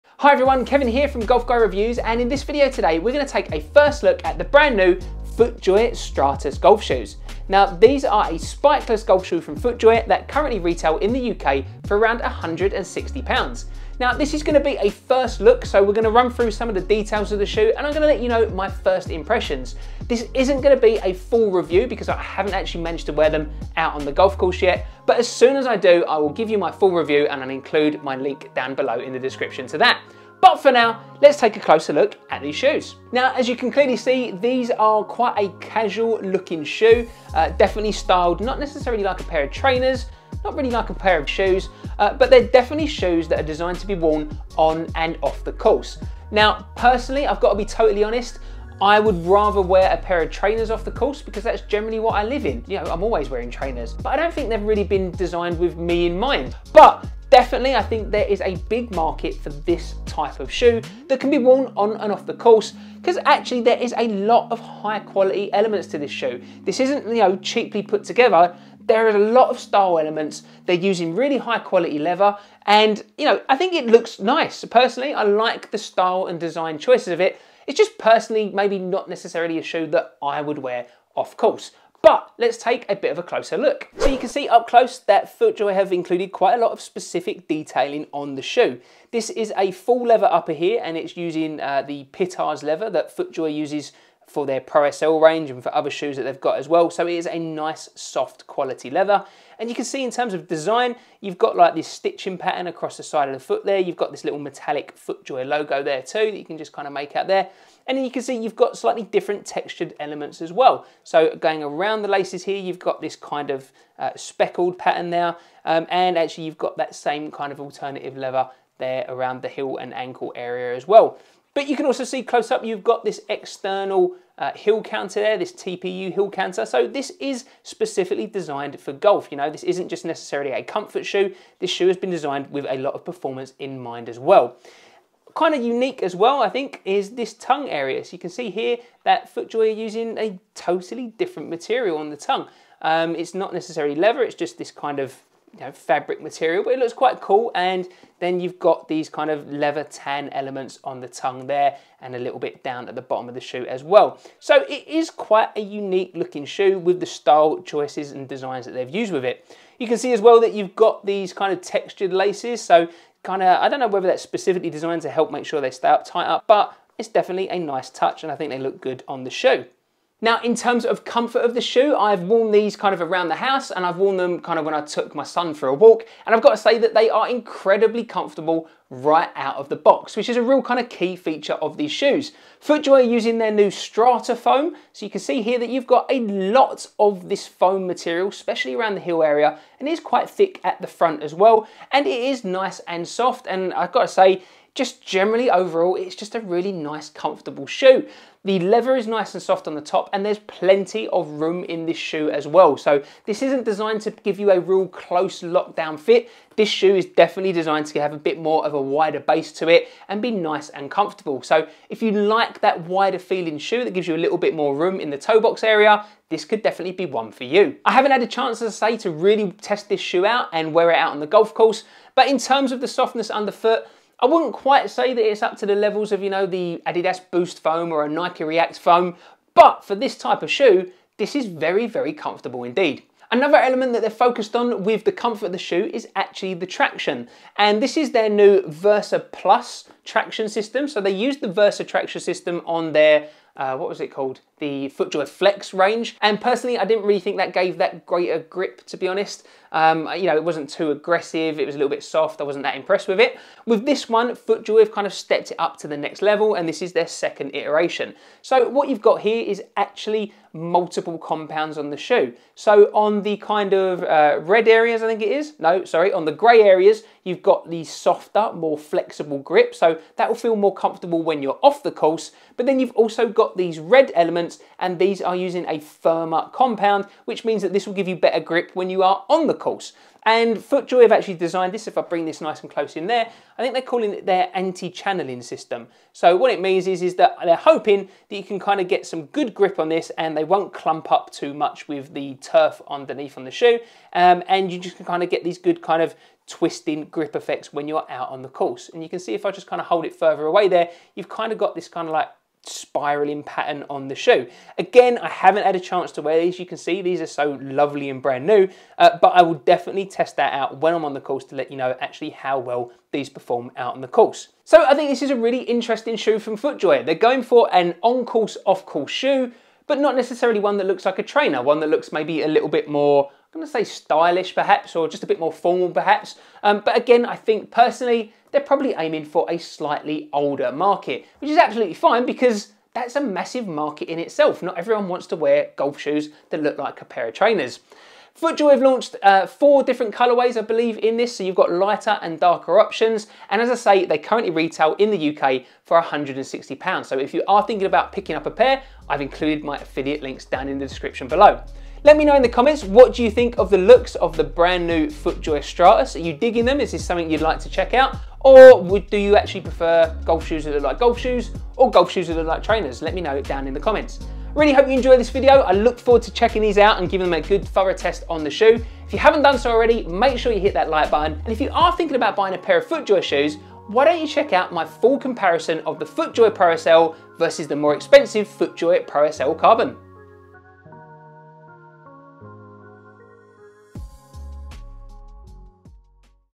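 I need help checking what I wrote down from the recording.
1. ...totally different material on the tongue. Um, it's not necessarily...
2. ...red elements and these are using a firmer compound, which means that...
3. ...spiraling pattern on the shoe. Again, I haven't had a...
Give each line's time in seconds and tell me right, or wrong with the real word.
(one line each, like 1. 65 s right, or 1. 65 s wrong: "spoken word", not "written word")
1. 140 s right
2. 273 s right
3. 302 s right.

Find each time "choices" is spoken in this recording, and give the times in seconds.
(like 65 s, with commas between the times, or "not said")
76 s, 157 s.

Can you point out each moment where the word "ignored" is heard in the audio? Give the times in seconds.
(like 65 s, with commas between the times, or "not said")
not said.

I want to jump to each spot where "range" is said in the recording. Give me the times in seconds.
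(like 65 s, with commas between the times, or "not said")
95 s, 245 s.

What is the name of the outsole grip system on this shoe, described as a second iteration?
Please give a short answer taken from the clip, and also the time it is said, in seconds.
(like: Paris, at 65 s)
Versa Plus, at 238 s.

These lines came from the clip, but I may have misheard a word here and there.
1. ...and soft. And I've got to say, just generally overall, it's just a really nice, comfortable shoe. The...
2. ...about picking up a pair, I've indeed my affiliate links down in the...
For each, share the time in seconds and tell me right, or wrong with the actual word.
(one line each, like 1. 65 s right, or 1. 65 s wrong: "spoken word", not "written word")
1. 192 s right
2. 347 s wrong: "included", not "indeed".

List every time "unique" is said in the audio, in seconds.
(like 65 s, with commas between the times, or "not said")
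135 s, 155 s.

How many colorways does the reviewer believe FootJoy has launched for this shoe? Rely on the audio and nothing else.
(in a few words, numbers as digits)
4.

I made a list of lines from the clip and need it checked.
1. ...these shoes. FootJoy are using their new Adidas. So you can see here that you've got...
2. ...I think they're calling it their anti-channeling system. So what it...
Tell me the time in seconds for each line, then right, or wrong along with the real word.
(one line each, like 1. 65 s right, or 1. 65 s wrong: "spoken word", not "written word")
1. 181 s wrong: "StratoFoam", not "Adidas"
2. 283 s right.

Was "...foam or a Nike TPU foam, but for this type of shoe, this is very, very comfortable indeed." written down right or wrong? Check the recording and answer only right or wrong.
wrong.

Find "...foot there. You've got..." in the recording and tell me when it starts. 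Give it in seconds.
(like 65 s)
103 s.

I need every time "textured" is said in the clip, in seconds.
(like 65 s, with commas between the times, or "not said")
109 s, 161 s.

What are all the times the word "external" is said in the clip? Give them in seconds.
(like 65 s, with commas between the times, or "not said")
123 s.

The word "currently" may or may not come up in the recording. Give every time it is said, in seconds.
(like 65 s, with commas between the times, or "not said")
10 s, 344 s.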